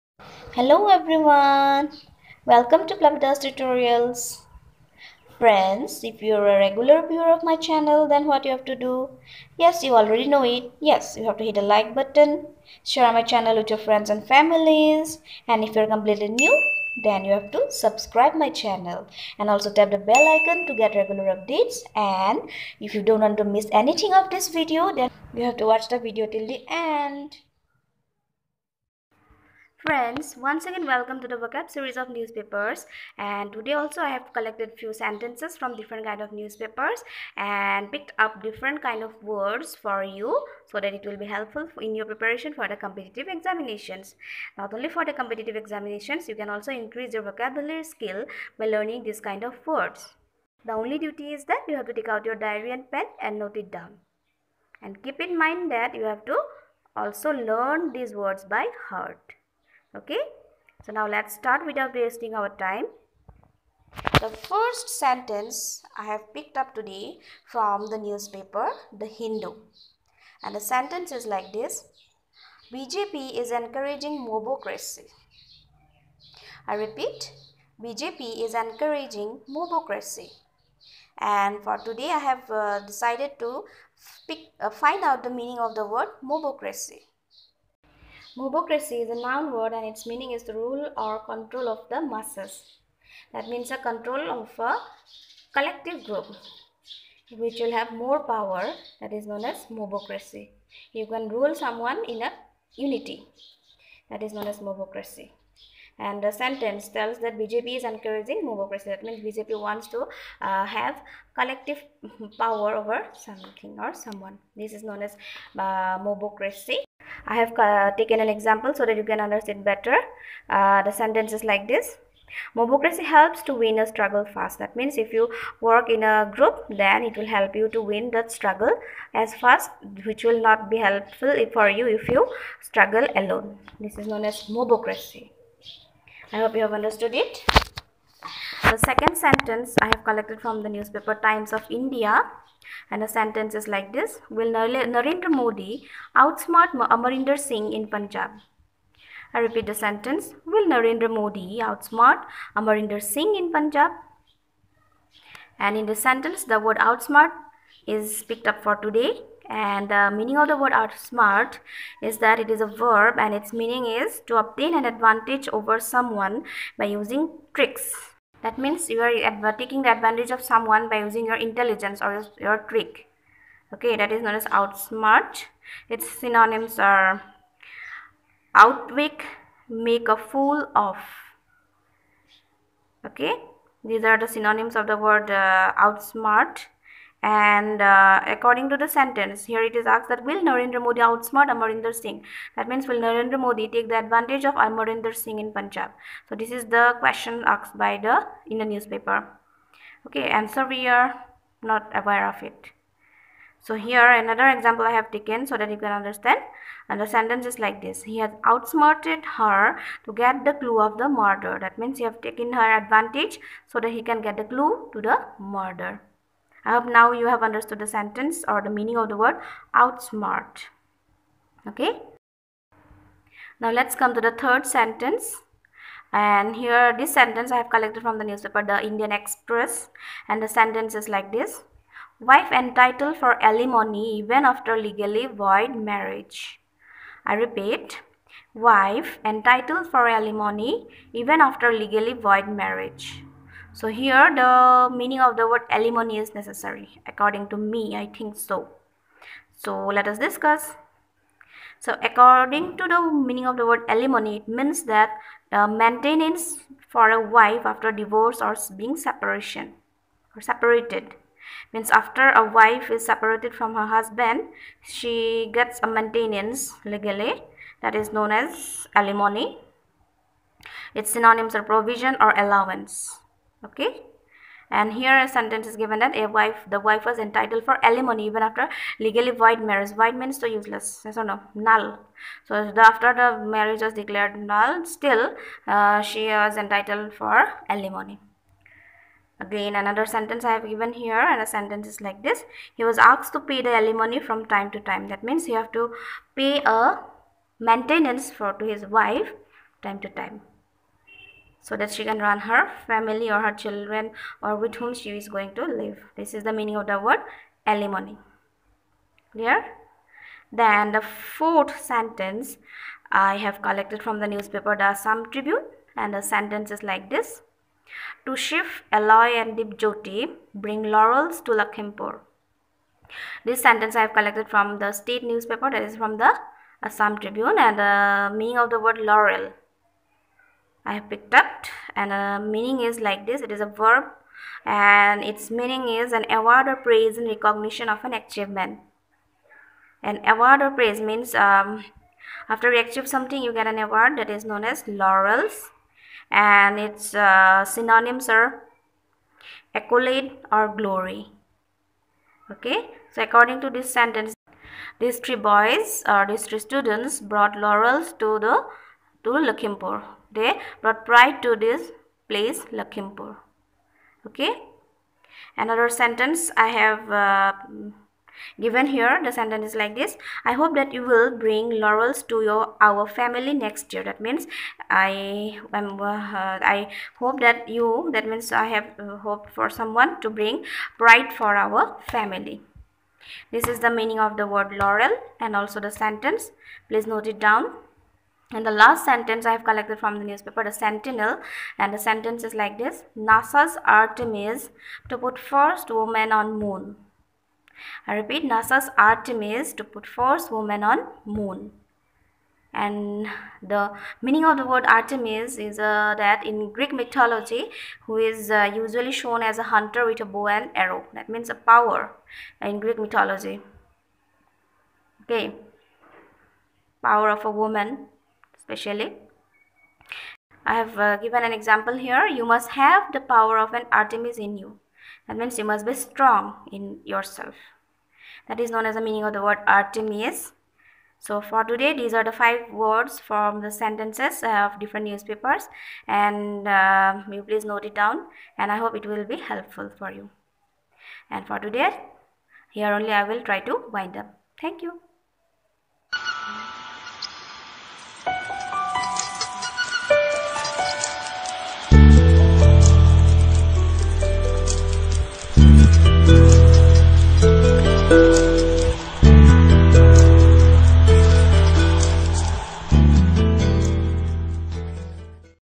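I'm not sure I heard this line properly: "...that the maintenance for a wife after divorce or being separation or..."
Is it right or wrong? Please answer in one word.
right.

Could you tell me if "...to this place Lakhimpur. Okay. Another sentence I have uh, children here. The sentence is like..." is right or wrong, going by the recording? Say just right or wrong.
wrong.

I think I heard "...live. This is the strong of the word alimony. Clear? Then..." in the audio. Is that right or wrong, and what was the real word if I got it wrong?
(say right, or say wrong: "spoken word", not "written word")
wrong: "meaning", not "strong".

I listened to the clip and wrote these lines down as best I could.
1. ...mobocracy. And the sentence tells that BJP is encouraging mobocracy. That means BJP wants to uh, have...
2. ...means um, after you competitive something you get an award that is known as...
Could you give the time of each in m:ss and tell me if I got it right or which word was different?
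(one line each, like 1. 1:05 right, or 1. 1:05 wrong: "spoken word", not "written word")
1. 1:44 right
2. 5:40 wrong: "achieve", not "competitive".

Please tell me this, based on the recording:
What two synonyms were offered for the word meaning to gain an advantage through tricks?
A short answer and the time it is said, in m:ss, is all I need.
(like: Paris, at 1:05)
Outwit, make a fool of, at 2:58.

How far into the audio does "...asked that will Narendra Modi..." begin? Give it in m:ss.
3:09.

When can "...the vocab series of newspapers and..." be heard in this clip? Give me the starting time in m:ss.
0:31.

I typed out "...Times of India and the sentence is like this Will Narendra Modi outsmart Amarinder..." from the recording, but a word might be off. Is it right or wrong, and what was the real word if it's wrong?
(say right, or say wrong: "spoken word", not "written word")
right.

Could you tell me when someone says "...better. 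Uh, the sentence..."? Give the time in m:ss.
1:59.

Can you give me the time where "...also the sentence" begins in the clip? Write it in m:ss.
6:25.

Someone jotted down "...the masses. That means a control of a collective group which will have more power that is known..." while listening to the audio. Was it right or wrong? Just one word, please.
right.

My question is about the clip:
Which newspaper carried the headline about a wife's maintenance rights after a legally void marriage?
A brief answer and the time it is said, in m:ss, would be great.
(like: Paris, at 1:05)
The Indian Express, at 3:48.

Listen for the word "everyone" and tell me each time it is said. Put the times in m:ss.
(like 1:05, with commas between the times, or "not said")
0:00.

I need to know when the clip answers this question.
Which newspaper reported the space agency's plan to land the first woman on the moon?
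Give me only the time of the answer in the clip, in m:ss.
6:30.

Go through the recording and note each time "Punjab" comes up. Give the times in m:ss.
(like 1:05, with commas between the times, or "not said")
2:27, 2:33, 3:15.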